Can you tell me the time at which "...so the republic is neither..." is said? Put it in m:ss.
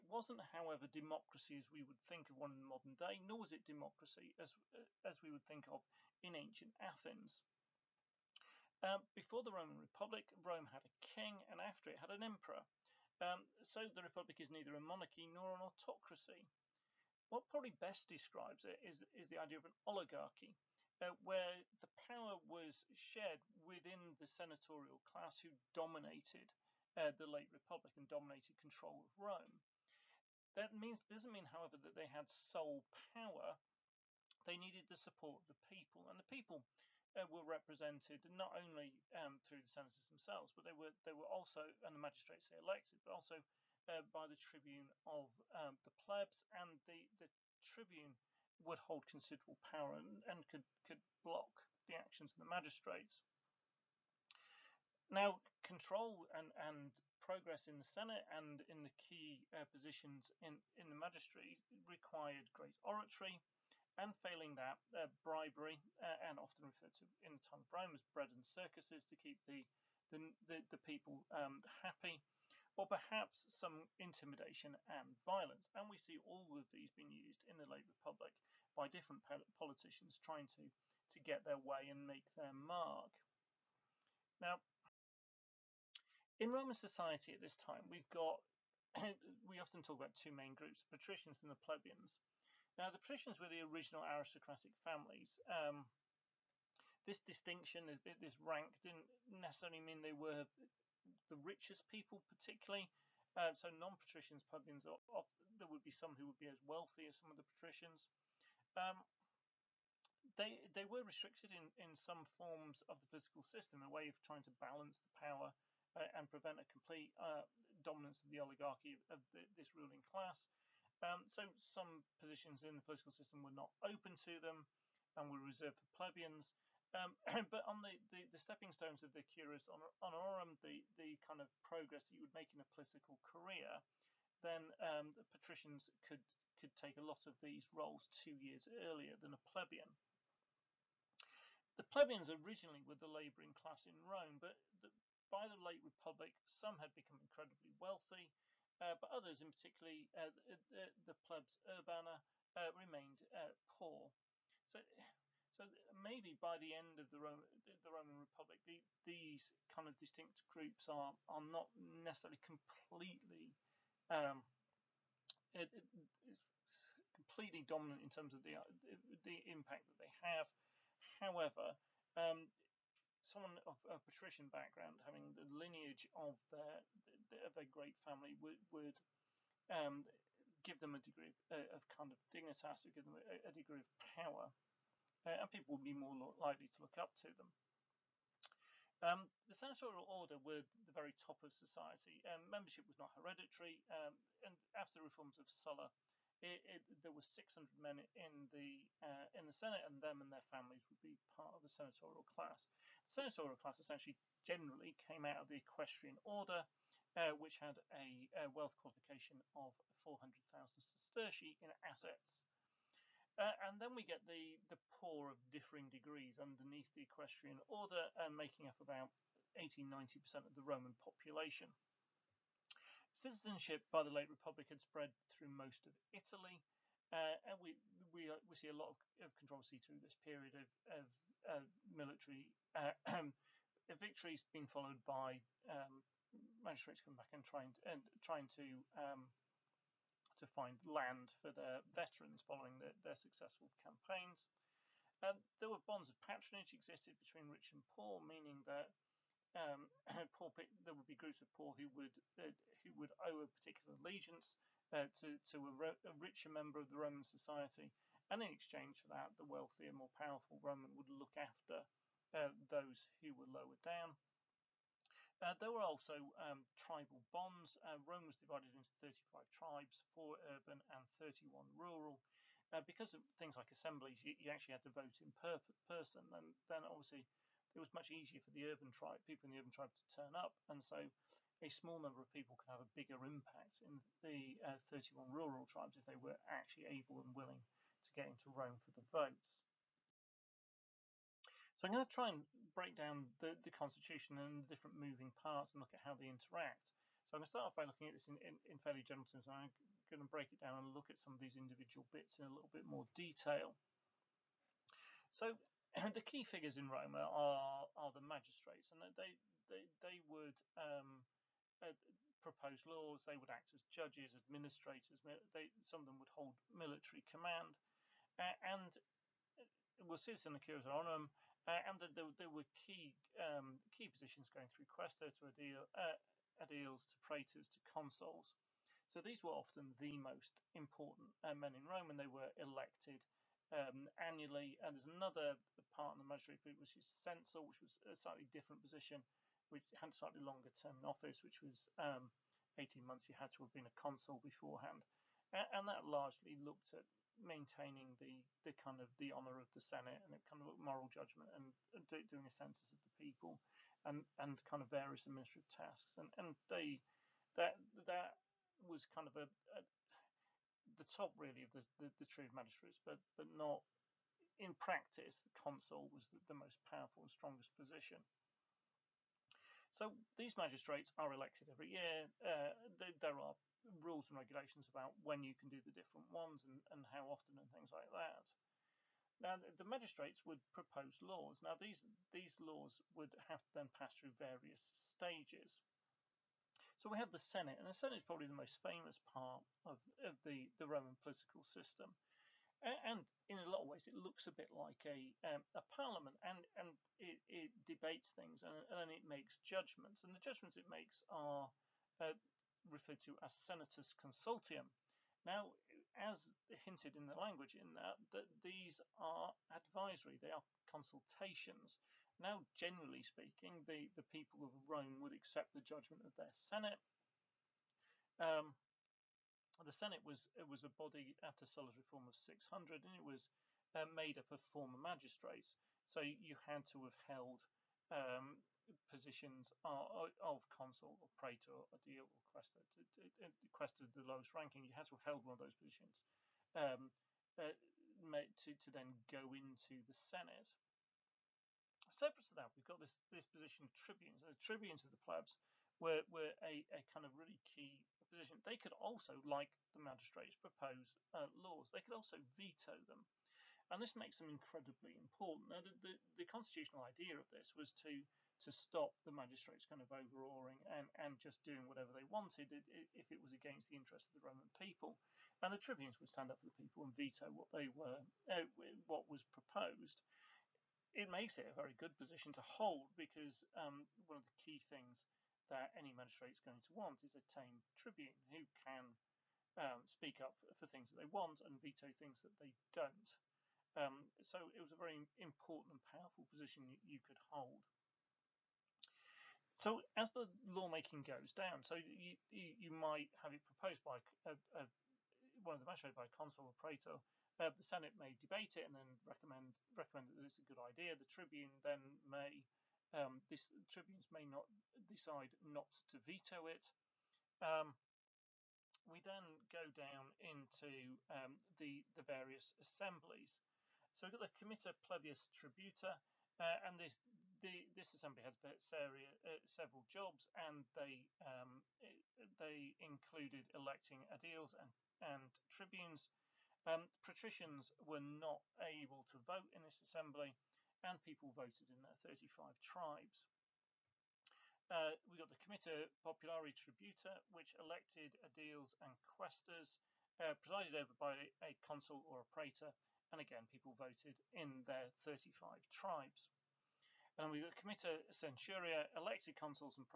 0:13.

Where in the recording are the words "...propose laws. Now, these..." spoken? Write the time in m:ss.
6:20.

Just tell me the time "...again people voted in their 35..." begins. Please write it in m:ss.
9:03.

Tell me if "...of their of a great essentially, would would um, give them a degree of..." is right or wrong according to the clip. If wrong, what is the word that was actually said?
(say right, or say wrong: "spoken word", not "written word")
wrong: "family", not "essentially".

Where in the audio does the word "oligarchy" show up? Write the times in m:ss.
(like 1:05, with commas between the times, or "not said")
0:19, 1:58.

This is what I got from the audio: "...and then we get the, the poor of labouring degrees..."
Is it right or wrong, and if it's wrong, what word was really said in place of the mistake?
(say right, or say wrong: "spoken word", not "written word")
wrong: "differing", not "labouring".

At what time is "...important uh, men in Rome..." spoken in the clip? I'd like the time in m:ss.
5:30.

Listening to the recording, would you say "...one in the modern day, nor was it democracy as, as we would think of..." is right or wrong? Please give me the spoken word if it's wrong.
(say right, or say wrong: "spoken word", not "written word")
right.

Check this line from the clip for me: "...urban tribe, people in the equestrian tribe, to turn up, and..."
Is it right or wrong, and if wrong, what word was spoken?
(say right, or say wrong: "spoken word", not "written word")
wrong: "urban", not "equestrian".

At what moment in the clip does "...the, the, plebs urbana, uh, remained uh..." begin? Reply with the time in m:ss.
2:30.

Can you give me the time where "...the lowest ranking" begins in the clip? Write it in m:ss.
7:14.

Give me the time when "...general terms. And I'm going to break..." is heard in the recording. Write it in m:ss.
4:59.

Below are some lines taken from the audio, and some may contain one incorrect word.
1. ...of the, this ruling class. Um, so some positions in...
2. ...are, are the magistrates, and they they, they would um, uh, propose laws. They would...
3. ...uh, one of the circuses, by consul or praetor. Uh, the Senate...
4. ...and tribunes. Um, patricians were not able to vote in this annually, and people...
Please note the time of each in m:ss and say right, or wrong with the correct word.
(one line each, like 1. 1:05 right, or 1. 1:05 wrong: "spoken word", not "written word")
1. 1:59 right
2. 5:07 right
3. 8:14 wrong: "magistrates", not "circuses"
4. 8:45 wrong: "assembly", not "annually".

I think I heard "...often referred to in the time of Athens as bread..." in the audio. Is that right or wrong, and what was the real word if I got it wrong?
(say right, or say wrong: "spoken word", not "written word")
wrong: "Rome", not "Athens".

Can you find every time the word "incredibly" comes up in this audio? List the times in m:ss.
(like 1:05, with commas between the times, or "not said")
2:27, 7:34.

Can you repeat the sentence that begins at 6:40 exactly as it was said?
And the judgments it makes are uh, referred to as senatus consultum.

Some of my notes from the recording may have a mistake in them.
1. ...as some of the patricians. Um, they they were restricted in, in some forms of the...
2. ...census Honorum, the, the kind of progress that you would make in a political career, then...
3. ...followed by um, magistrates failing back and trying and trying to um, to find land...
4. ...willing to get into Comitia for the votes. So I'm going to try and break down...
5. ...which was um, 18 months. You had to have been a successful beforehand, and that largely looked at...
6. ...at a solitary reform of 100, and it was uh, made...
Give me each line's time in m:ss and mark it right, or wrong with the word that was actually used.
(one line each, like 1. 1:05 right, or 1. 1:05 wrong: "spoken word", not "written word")
1. 1:47 right
2. 2:09 wrong: "curious", not "census"
3. 3:54 wrong: "coming", not "failing"
4. 4:47 wrong: "Rome", not "Comitia"
5. 5:41 wrong: "consul", not "successful"
6. 7:01 wrong: "600", not "100".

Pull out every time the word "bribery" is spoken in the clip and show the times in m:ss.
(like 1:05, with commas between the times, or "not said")
1:05.